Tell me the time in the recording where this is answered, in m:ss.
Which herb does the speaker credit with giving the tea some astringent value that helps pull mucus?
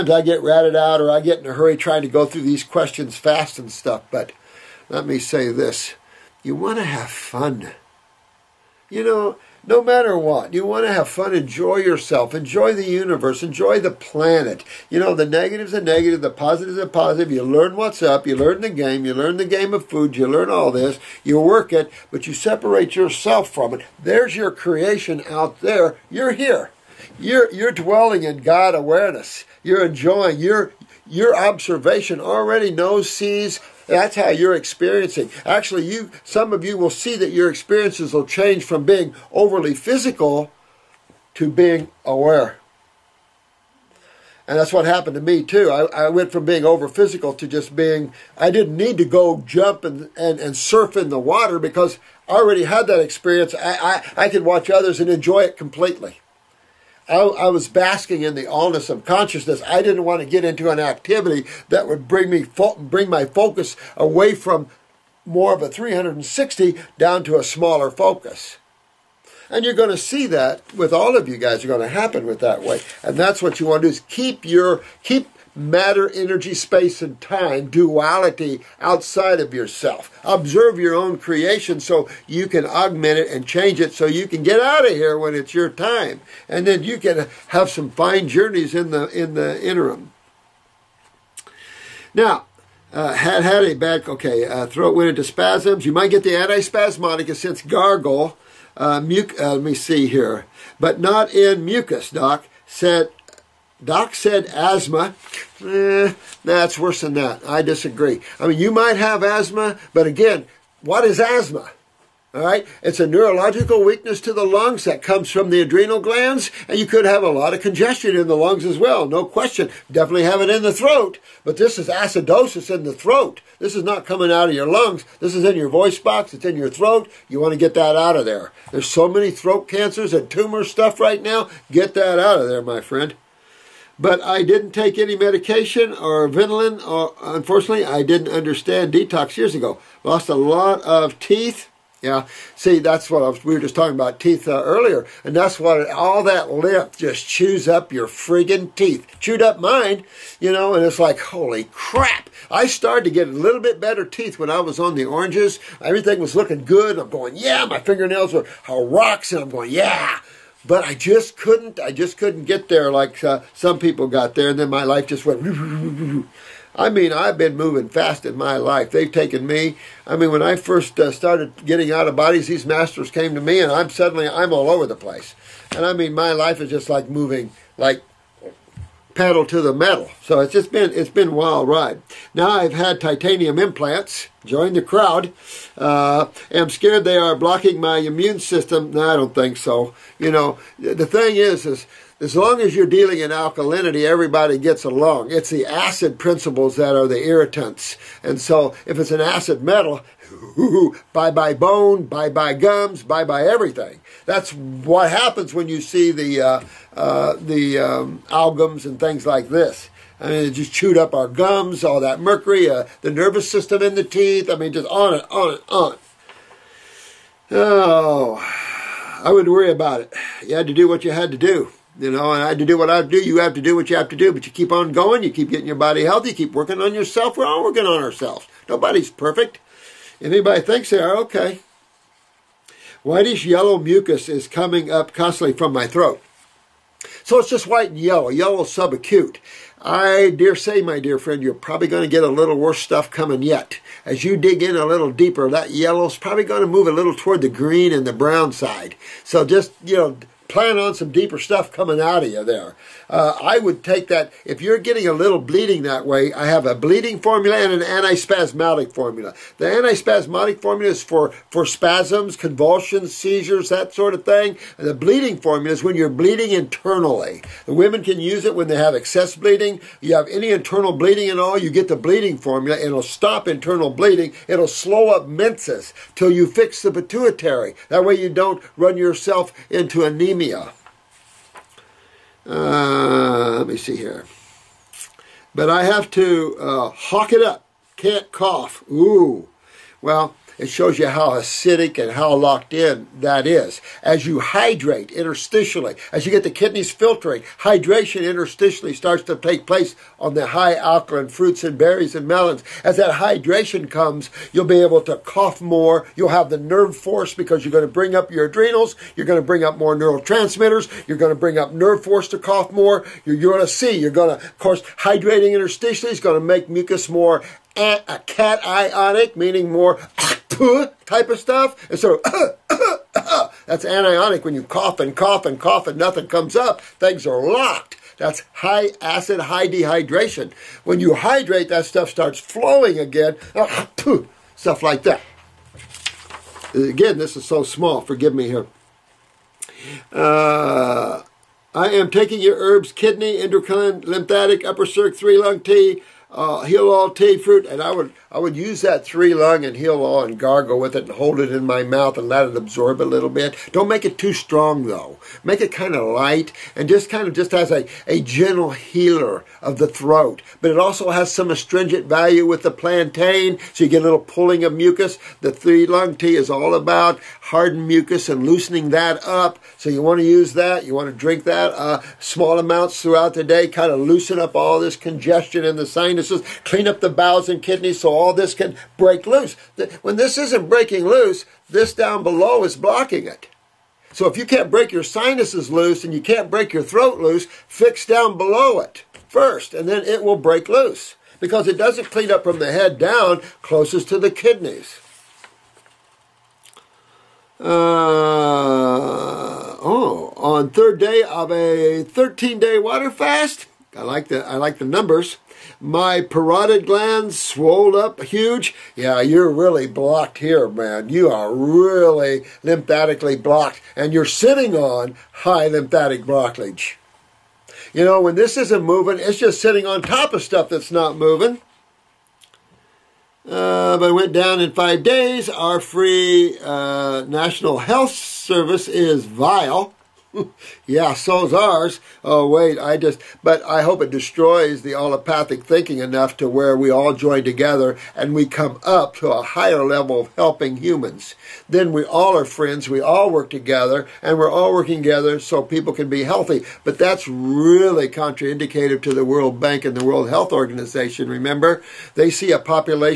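6:02.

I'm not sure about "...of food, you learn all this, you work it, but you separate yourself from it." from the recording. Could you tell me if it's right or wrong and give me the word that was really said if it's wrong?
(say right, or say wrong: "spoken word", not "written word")
right.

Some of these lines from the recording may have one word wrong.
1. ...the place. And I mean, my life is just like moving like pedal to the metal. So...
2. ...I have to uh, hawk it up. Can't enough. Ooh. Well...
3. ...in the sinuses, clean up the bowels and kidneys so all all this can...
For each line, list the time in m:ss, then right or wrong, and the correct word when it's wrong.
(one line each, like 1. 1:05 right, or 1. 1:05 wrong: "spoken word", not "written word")
1. 2:54 right
2. 4:45 wrong: "cough", not "enough"
3. 6:15 right.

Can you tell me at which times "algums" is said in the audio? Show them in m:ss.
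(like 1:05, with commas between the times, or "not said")
3:28.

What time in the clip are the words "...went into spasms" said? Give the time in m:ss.
1:34.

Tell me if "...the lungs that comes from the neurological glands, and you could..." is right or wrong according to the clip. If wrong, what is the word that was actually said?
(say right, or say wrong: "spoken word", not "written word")
wrong: "adrenal", not "neurological".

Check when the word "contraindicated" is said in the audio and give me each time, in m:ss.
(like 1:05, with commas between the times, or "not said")
7:28.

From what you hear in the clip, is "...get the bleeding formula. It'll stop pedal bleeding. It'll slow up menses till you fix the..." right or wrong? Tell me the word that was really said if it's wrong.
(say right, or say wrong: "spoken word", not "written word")
wrong: "internal", not "pedal".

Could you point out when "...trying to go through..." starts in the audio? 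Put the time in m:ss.
0:01.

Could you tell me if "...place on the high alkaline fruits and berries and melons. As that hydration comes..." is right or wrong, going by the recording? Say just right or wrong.
right.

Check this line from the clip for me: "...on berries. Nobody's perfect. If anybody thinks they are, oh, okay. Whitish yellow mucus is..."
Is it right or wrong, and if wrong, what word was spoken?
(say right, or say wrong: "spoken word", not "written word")
wrong: "ourselves", not "berries".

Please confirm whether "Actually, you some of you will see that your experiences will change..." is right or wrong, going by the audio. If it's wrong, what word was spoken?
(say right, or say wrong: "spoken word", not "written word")
right.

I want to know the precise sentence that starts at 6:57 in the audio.
You know, when this isn't moving, it's just sitting on top of stuff that's not moving.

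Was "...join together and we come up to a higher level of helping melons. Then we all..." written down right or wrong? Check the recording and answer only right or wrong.
wrong.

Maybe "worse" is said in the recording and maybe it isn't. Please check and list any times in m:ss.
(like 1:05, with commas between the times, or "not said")
1:46, 4:02.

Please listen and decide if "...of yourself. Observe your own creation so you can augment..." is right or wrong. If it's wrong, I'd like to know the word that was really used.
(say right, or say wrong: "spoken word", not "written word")
right.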